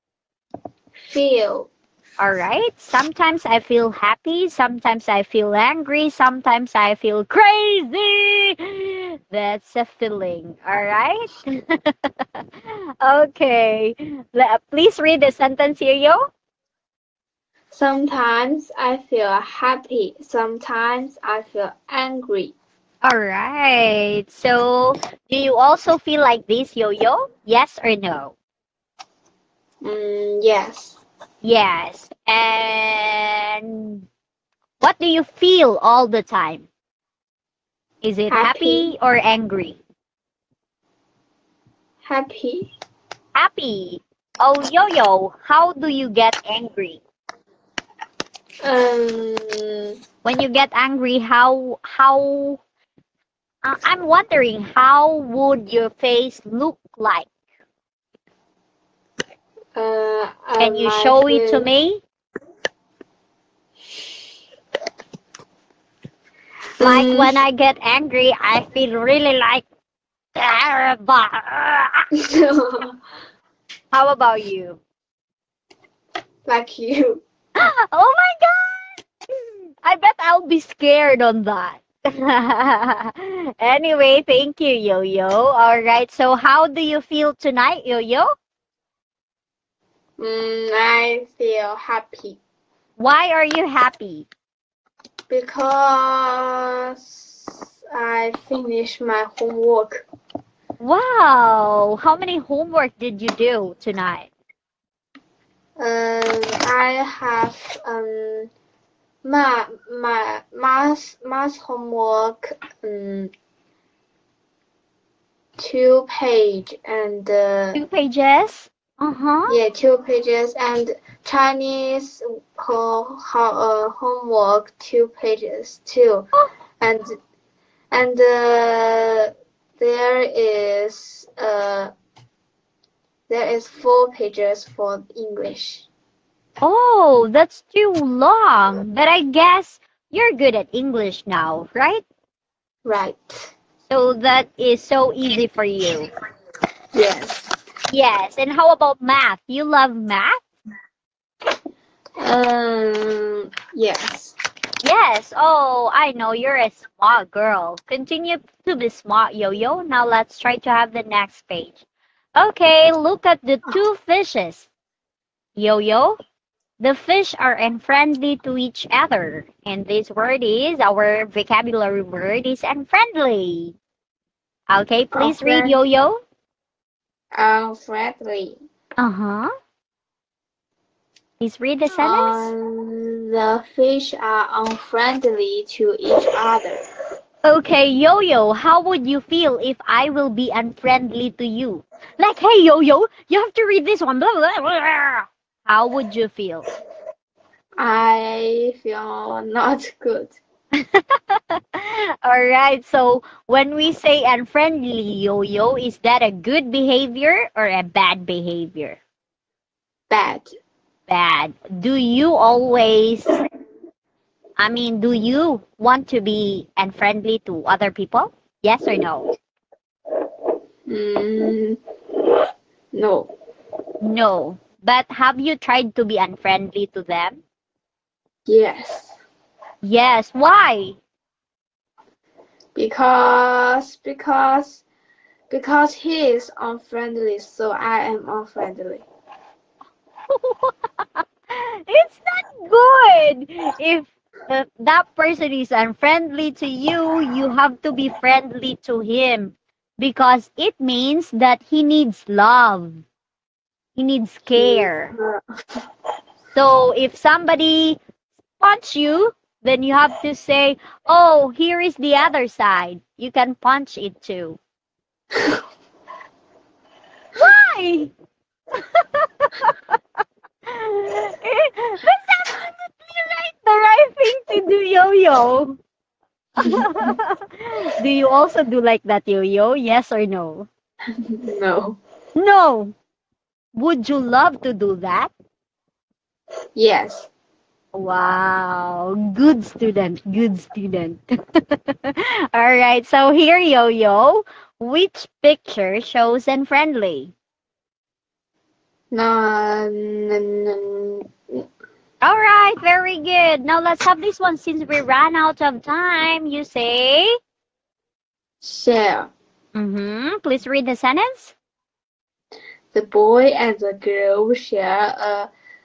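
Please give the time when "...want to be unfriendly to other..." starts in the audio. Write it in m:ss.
3:35.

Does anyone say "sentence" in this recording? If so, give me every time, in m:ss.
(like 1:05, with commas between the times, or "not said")
0:15, 3:01, 5:10.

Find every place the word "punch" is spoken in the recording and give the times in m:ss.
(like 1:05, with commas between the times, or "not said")
4:18, 4:23.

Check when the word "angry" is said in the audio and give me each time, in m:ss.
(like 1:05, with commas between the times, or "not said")
0:05, 0:21, 0:39, 0:46, 0:50, 1:07.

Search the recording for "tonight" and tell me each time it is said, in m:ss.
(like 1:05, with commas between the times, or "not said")
1:27, 1:43.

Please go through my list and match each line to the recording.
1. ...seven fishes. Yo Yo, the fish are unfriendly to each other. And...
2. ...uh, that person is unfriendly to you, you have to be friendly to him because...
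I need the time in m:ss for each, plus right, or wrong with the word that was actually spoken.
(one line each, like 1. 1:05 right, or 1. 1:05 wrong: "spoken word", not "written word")
1. 2:43 wrong: "two", not "seven"
2. 4:04 right.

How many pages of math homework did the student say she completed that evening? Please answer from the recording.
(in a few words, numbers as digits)
2.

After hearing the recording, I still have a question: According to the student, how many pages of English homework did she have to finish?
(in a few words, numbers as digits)
4.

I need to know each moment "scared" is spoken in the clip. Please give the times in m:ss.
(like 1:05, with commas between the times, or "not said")
1:20.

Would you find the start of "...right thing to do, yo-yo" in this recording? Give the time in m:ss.
4:33.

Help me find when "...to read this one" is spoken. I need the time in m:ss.
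3:13.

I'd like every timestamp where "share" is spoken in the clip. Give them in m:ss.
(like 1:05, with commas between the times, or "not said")
5:08, 5:14.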